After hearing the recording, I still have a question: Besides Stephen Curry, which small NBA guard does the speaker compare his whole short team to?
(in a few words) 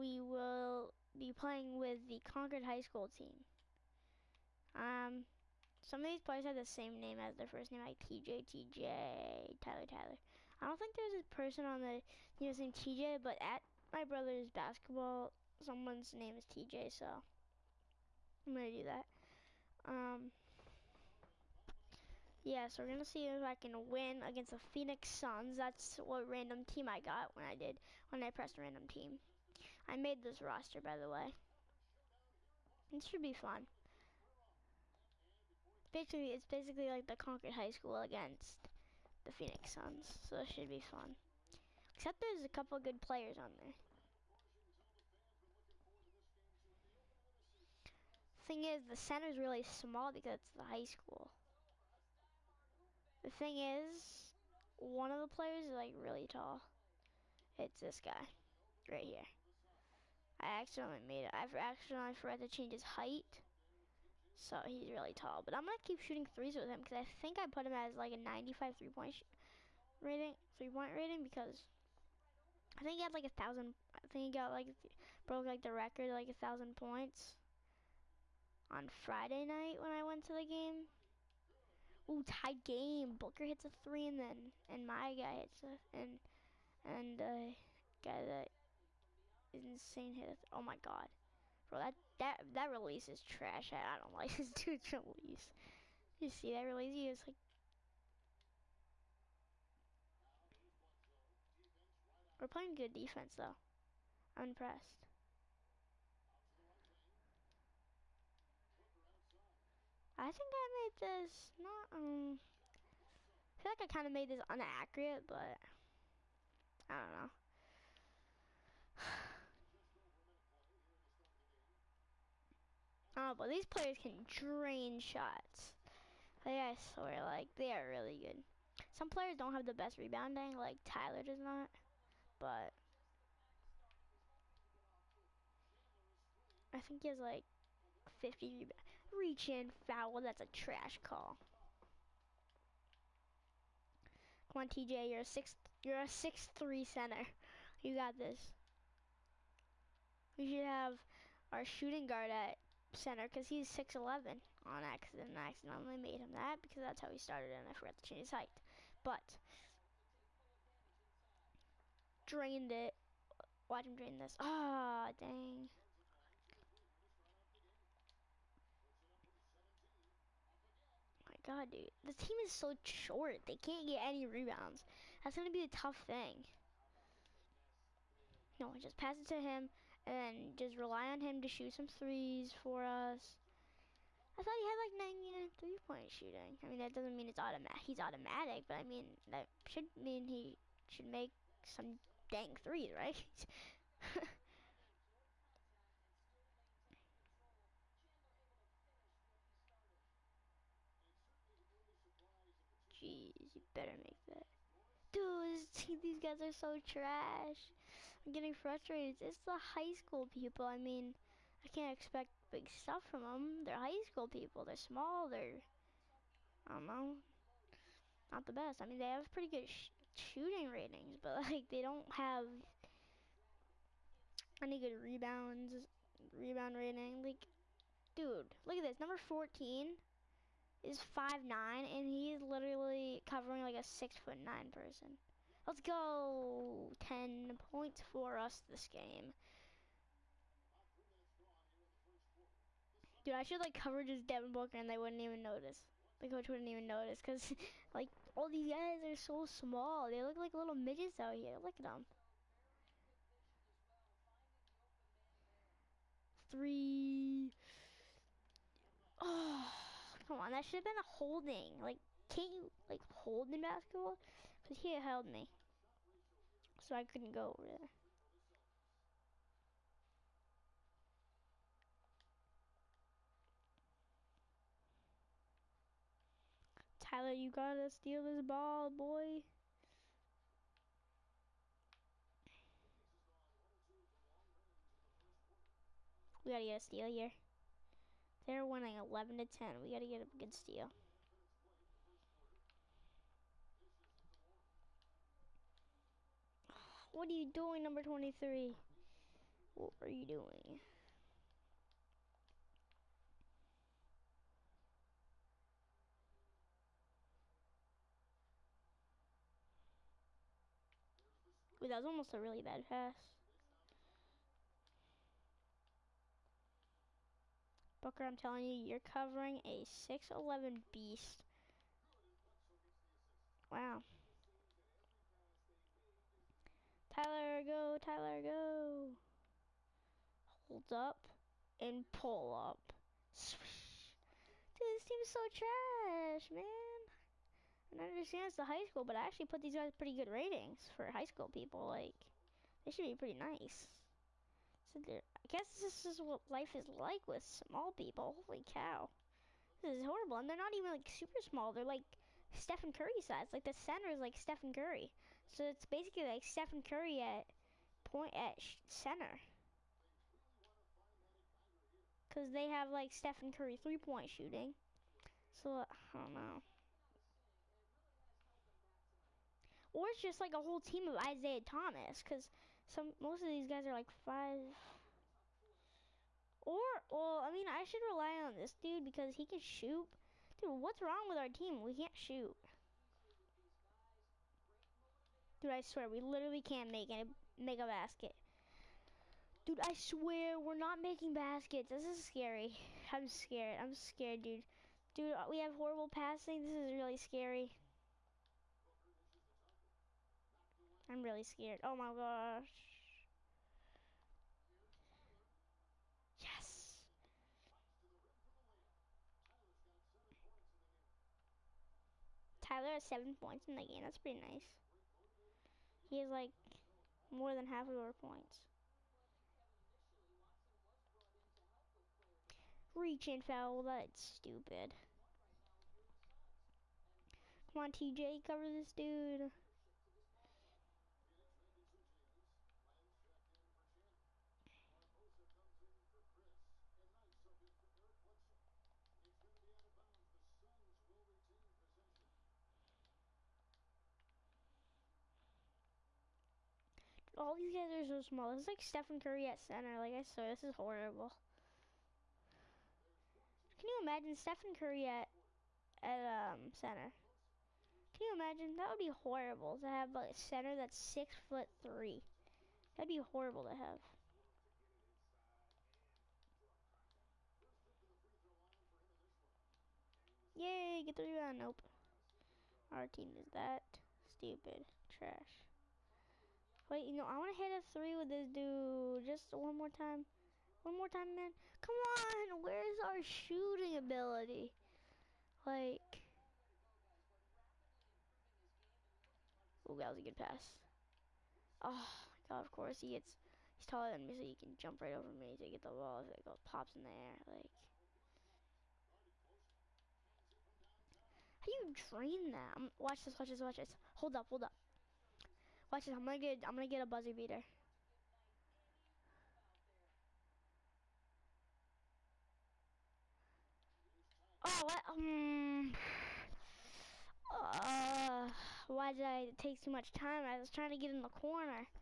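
Isaiah Thomas.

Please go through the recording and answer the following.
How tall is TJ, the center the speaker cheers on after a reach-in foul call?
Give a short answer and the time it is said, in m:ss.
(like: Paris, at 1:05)
6'3, at 2:26.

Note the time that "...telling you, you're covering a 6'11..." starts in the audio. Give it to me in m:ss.
5:18.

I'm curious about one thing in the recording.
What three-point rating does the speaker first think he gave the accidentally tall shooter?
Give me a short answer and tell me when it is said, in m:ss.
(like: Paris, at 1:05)
95, at 1:08.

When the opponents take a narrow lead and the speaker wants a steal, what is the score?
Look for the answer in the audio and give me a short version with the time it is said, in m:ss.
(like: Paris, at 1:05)
11 to 10, at 4:48.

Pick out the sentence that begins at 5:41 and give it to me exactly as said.
Like, they should be pretty nice.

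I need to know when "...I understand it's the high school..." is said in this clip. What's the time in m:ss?
5:38.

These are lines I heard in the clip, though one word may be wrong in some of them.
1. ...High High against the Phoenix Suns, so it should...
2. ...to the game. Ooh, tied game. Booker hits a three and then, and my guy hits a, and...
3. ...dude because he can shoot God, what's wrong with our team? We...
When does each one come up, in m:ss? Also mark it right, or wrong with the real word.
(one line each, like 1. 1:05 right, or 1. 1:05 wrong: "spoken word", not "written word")
1. 0:37 wrong: "School", not "High"
2. 1:20 right
3. 6:18 wrong: "Dude", not "God".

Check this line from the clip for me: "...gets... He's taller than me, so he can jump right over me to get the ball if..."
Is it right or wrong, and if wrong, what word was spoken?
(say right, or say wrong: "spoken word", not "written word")
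right.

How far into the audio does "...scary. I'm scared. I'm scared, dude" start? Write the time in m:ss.
6:32.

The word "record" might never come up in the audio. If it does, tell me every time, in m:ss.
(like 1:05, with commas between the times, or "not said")
1:15.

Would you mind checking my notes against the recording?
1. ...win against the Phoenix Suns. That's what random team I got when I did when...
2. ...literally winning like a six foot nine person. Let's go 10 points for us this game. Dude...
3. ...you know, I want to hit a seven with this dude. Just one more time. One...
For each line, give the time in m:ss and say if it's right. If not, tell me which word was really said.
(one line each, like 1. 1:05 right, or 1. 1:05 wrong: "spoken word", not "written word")
1. 0:23 right
2. 3:52 wrong: "covering", not "winning"
3. 7:57 wrong: "three", not "seven".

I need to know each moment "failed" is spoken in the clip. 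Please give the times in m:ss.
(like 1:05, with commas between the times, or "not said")
not said.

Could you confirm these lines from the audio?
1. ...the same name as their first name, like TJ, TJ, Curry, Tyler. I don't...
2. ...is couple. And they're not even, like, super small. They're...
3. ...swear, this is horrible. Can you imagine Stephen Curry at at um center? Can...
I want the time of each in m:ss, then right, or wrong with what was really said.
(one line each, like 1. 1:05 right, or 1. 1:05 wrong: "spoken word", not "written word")
1. 0:06 wrong: "Tyler", not "Curry"
2. 5:49 wrong: "horrible", not "couple"
3. 7:30 right.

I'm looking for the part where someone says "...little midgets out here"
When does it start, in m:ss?
4:10.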